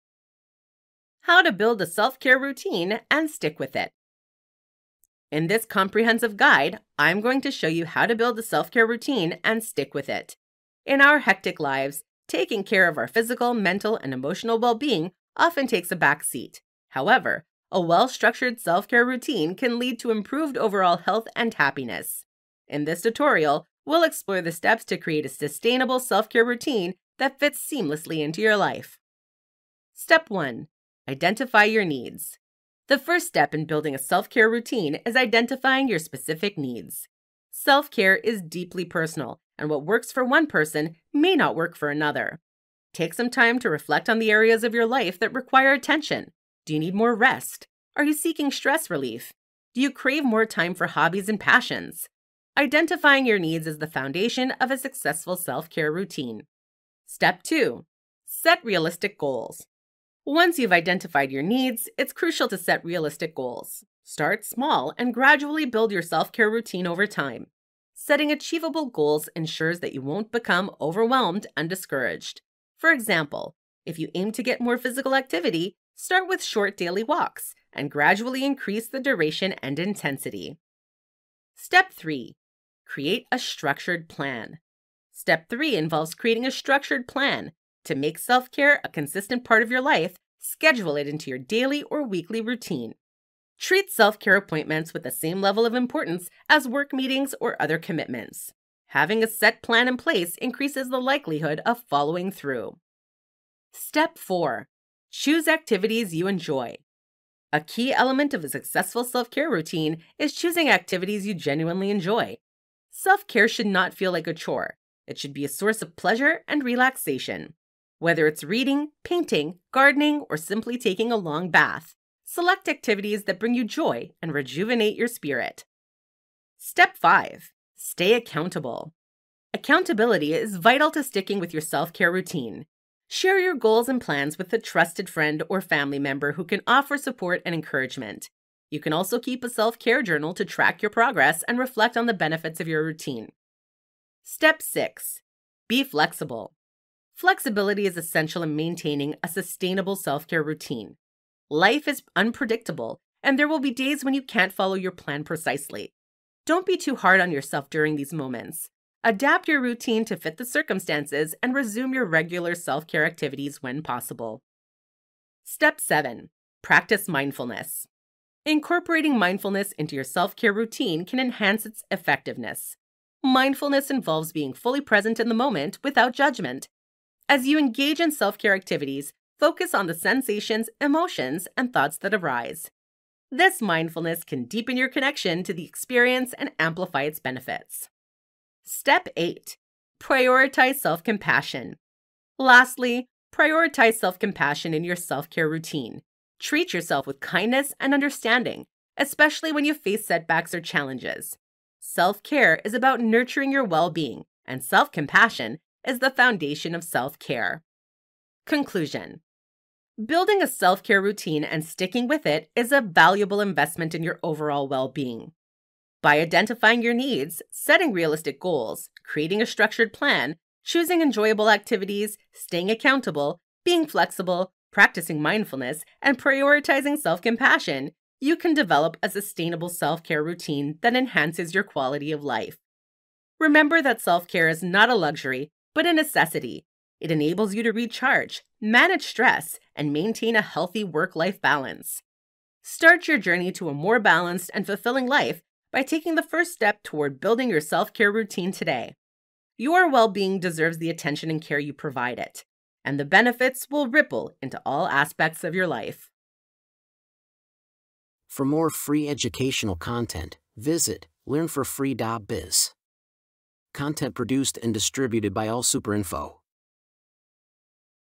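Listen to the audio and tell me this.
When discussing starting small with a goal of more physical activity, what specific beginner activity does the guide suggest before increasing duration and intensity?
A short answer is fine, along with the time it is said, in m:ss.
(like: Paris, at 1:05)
short daily walks, at 1:16.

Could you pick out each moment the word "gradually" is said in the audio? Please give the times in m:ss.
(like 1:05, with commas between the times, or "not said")
1:05, 1:17.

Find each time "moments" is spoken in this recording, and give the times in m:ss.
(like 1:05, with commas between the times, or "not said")
2:38, 2:55.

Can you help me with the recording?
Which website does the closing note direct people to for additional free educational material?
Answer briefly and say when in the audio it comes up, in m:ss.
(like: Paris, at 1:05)
learnforfree.biz, at 4:21.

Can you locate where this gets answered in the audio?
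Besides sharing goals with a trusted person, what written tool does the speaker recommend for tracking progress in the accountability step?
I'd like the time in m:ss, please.
2:19.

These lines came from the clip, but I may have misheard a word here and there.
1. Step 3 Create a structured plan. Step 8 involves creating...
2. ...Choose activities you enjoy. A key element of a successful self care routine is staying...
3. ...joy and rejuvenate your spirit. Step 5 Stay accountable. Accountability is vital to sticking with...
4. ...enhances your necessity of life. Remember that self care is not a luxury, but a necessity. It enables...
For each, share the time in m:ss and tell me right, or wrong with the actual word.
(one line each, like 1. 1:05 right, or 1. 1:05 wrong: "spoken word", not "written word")
1. 1:21 wrong: "3", not "8"
2. 1:45 wrong: "choosing", not "staying"
3. 2:03 right
4. 3:50 wrong: "quality", not "necessity".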